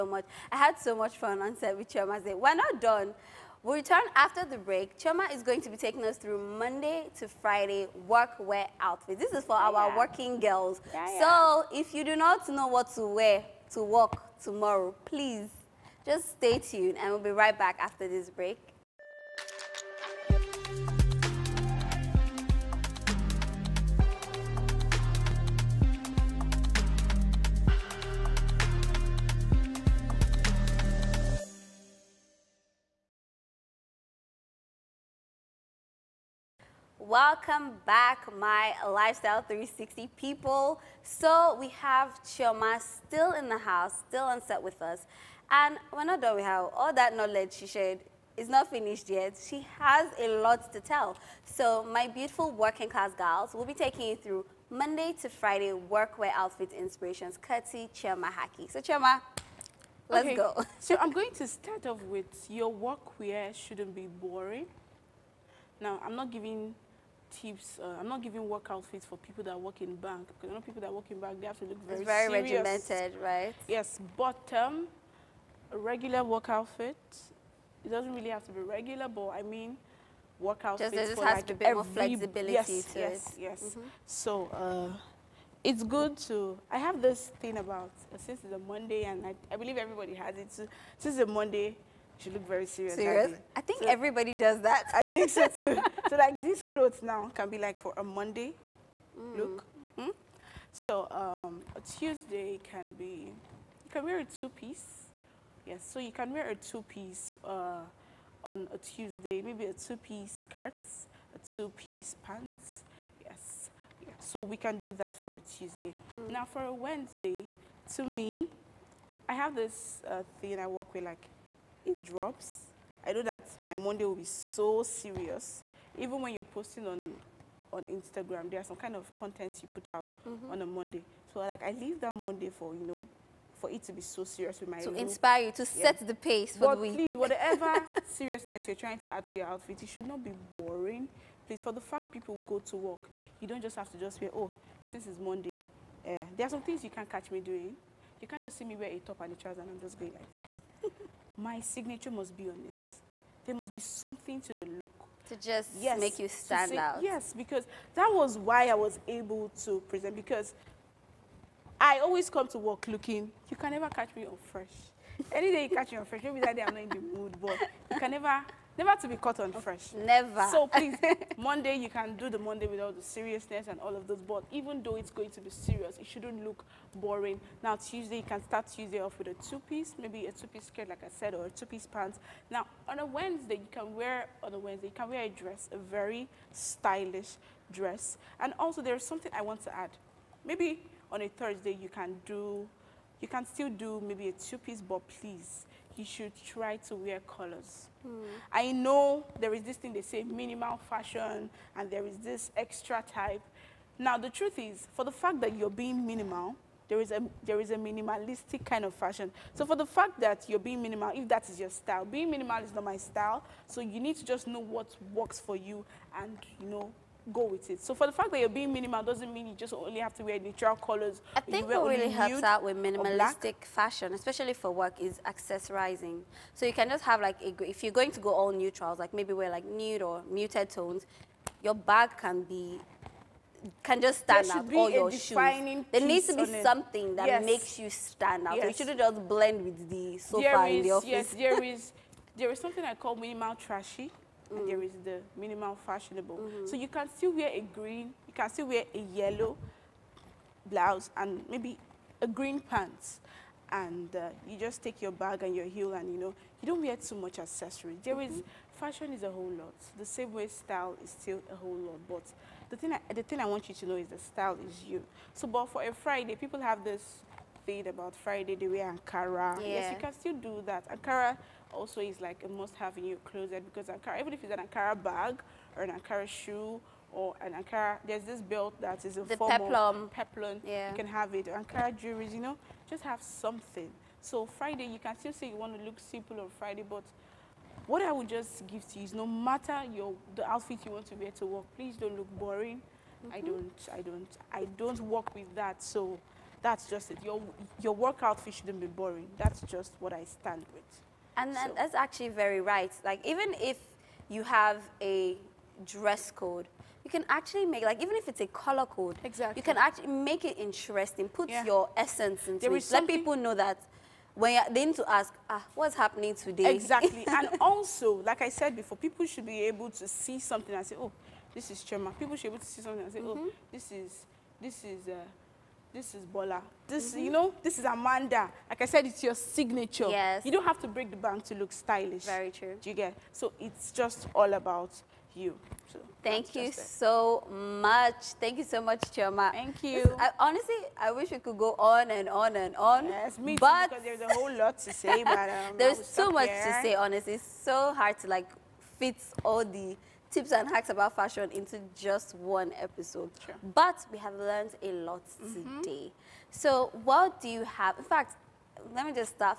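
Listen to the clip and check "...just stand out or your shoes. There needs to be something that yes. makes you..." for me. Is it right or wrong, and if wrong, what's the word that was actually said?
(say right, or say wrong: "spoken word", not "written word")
right.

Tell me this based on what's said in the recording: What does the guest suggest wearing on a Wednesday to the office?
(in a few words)
a very stylish dress.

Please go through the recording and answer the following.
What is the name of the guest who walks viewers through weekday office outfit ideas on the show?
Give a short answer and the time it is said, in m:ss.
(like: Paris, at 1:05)
Chioma Haki, at 0:57.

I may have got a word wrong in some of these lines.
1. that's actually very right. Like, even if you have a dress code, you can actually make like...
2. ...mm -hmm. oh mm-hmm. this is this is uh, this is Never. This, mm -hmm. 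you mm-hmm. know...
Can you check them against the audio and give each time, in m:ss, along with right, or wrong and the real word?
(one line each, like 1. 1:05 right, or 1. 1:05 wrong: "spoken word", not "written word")
1. 5:01 right
2. 5:23 wrong: "Bola", not "Never".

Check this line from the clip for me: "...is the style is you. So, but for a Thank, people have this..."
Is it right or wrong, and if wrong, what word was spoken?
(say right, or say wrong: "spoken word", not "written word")
wrong: "Friday", not "Thank".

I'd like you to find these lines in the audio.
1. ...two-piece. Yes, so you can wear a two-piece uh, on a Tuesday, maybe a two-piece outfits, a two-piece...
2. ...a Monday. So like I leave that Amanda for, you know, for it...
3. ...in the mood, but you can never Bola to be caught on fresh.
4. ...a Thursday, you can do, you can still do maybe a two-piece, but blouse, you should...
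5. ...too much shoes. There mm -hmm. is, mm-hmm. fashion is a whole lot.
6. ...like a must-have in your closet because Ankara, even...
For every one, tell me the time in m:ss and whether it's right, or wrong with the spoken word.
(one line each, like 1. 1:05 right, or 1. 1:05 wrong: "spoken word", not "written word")
1. 1:44 wrong: "skirts", not "outfits"
2. 2:10 wrong: "Monday", not "Amanda"
3. 2:46 wrong: "Never", not "Bola"
4. 3:11 wrong: "please", not "blouse"
5. 4:16 wrong: "accessories", not "shoes"
6. 4:32 right.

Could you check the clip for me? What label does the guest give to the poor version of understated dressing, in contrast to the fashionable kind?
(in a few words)
minimal trashy.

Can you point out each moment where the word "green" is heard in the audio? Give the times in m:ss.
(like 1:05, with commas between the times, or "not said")
4:07, 4:12.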